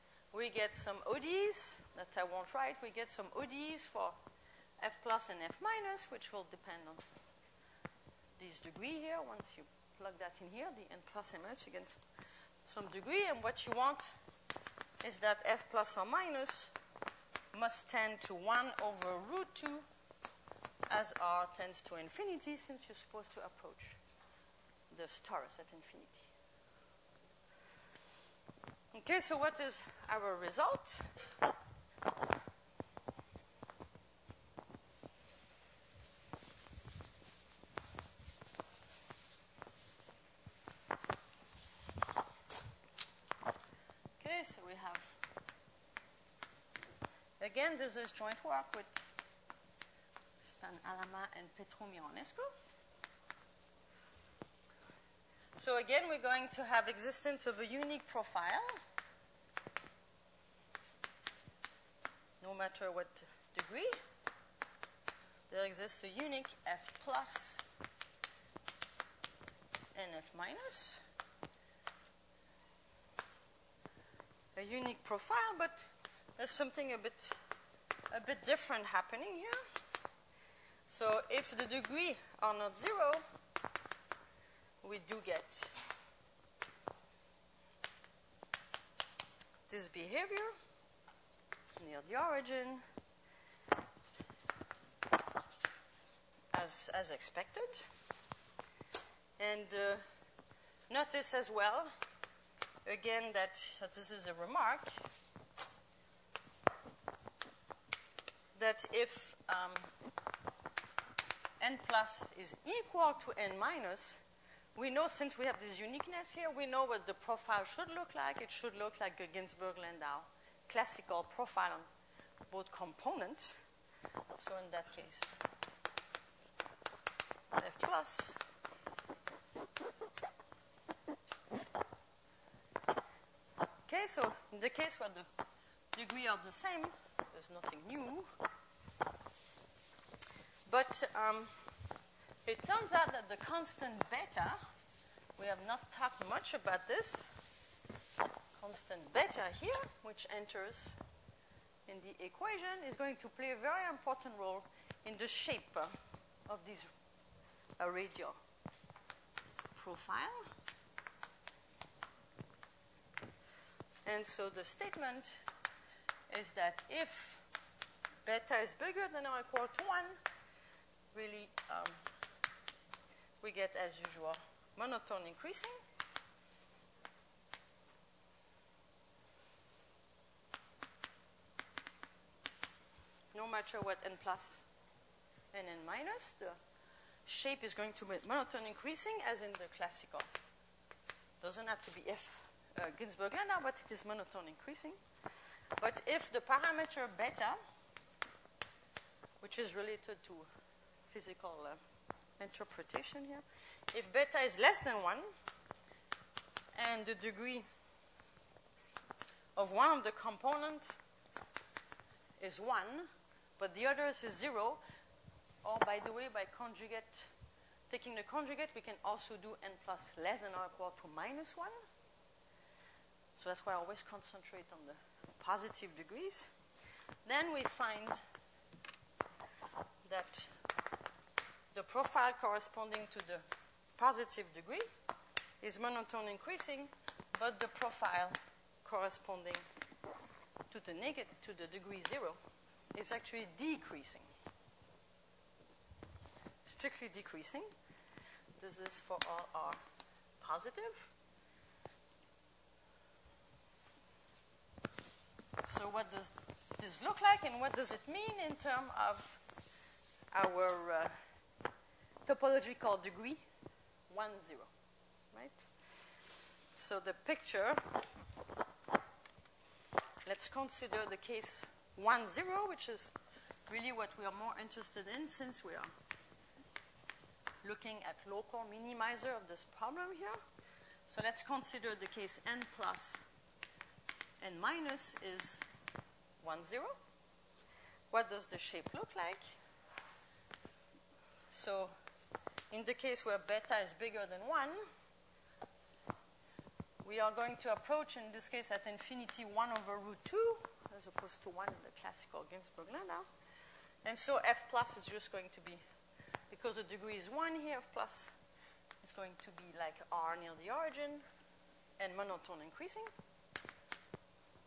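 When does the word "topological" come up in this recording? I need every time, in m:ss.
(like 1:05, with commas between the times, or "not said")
4:22.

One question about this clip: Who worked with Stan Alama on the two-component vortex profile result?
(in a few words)
Petru Mironescu.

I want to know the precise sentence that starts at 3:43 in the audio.
So that's why I always concentrate on the positive degrees.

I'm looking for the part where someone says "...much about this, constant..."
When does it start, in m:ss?
2:26.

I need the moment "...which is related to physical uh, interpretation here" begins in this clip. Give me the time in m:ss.
3:19.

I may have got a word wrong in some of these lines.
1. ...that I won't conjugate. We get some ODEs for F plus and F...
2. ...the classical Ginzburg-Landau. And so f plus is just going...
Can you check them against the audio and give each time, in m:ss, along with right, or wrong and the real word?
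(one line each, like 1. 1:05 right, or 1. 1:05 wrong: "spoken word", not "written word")
1. 0:01 wrong: "write", not "conjugate"
2. 5:01 right.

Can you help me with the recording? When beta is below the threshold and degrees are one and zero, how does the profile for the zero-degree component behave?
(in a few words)
strictly decreasing.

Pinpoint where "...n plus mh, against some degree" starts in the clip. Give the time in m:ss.
0:10.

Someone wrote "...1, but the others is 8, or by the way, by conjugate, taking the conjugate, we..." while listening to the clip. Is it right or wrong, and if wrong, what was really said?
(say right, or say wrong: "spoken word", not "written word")
wrong: "0", not "8".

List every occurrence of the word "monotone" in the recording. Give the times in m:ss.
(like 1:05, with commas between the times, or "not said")
2:54, 3:08, 3:14, 3:55, 5:12.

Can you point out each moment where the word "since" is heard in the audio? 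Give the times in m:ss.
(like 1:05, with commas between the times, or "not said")
0:22, 1:55, 4:35.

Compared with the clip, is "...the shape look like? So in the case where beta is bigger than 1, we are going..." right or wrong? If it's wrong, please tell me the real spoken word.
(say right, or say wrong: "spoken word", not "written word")
right.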